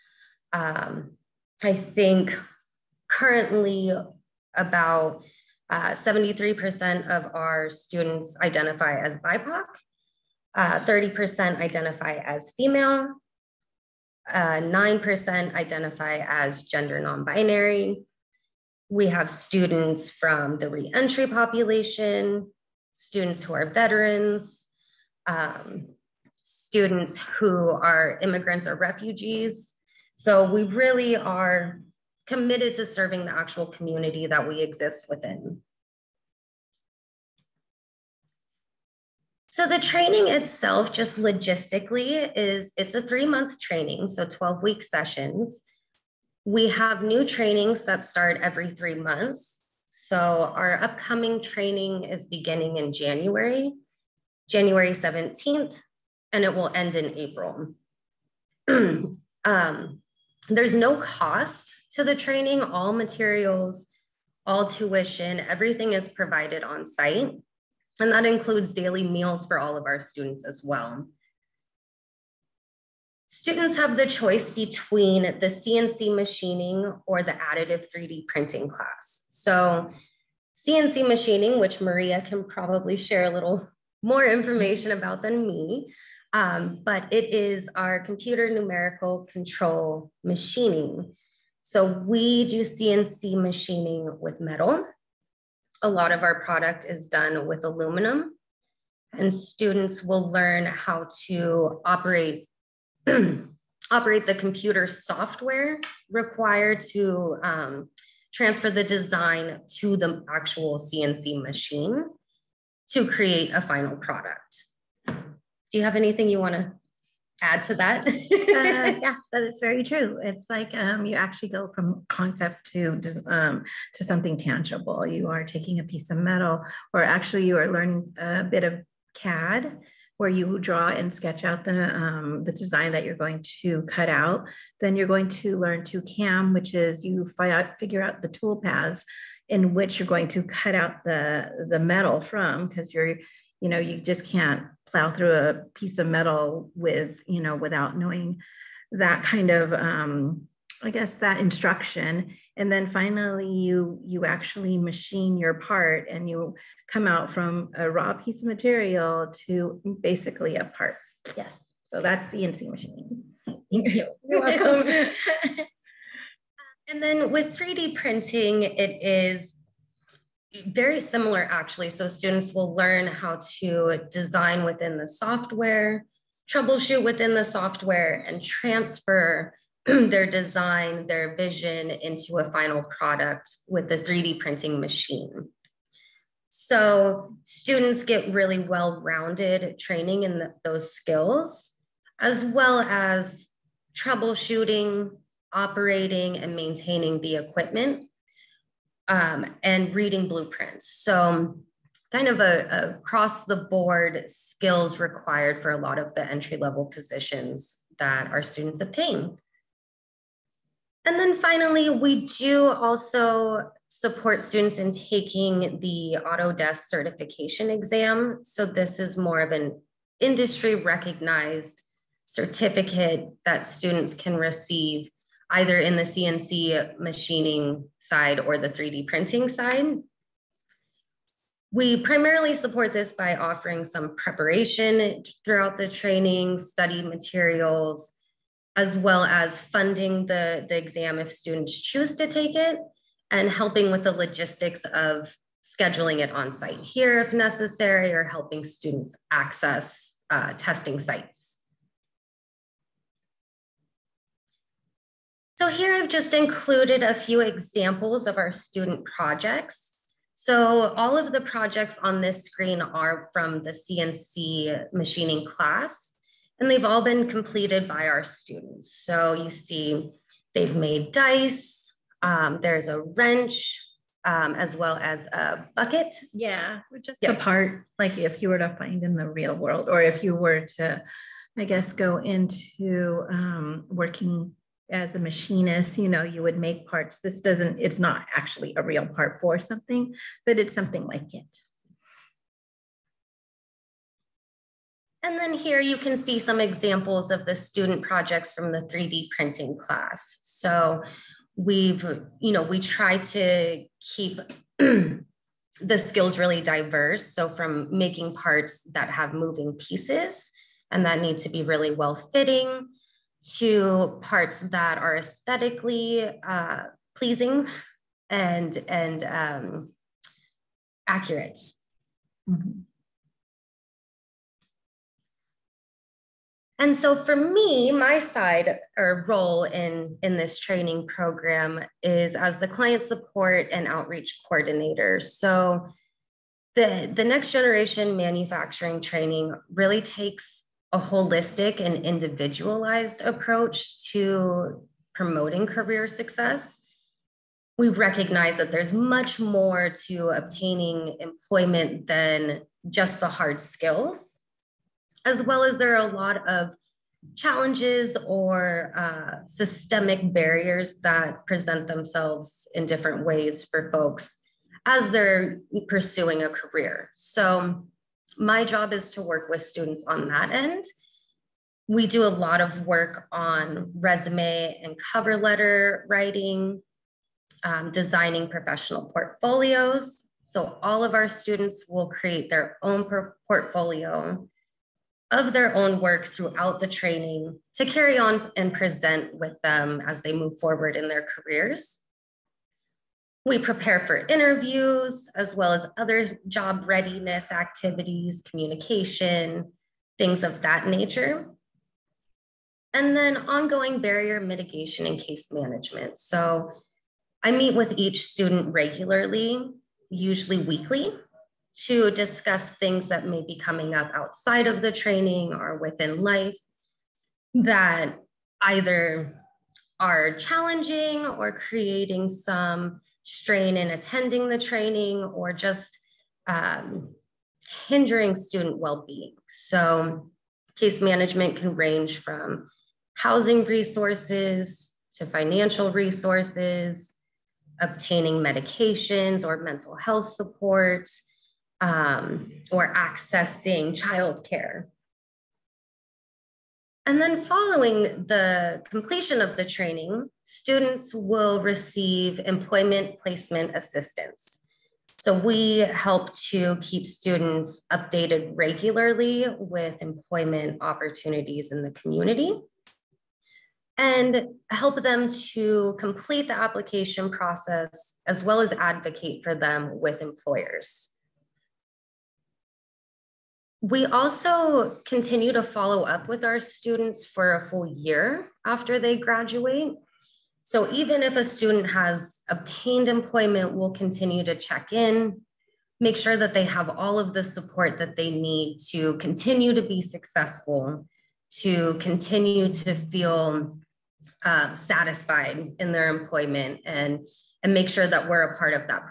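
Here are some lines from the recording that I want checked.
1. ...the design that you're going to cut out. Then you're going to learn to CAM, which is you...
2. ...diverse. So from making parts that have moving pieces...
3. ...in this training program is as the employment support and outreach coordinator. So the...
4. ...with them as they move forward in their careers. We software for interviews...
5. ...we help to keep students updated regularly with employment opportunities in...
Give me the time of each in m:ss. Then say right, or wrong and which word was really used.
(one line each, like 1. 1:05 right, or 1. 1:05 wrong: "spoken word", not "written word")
1. 2:12 right
2. 5:06 right
3. 5:30 wrong: "client", not "employment"
4. 6:29 wrong: "prepare", not "software"
5. 7:35 right.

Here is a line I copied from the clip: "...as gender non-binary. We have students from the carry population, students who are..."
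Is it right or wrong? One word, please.
wrong.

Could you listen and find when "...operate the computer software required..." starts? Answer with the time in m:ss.
1:43.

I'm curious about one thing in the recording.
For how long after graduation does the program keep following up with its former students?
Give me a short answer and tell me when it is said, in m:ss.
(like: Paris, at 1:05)
A full year, at 7:57.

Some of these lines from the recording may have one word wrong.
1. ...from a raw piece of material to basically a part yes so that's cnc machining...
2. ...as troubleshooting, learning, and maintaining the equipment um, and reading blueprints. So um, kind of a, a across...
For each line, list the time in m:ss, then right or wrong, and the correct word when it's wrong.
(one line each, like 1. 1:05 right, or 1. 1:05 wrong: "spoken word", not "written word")
1. 2:37 right
2. 3:12 wrong: "operating", not "learning".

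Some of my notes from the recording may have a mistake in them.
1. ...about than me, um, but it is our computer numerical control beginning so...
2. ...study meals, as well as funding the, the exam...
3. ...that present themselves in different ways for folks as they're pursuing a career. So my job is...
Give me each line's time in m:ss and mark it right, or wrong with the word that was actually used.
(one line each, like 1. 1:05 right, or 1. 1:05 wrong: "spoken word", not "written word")
1. 1:24 wrong: "machining", not "beginning"
2. 3:56 wrong: "materials", not "meals"
3. 6:01 right.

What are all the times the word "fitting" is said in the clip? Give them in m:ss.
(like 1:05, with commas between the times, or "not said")
5:12.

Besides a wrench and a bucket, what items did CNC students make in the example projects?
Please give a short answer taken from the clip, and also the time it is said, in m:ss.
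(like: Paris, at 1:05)
Dice, at 4:31.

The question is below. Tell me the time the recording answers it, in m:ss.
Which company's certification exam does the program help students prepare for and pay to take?
3:36.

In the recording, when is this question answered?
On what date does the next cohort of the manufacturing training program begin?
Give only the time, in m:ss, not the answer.
0:54.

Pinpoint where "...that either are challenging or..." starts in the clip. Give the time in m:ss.
6:57.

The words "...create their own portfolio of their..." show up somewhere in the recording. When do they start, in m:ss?
6:22.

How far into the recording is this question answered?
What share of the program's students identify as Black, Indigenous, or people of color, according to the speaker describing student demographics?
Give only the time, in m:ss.
0:05.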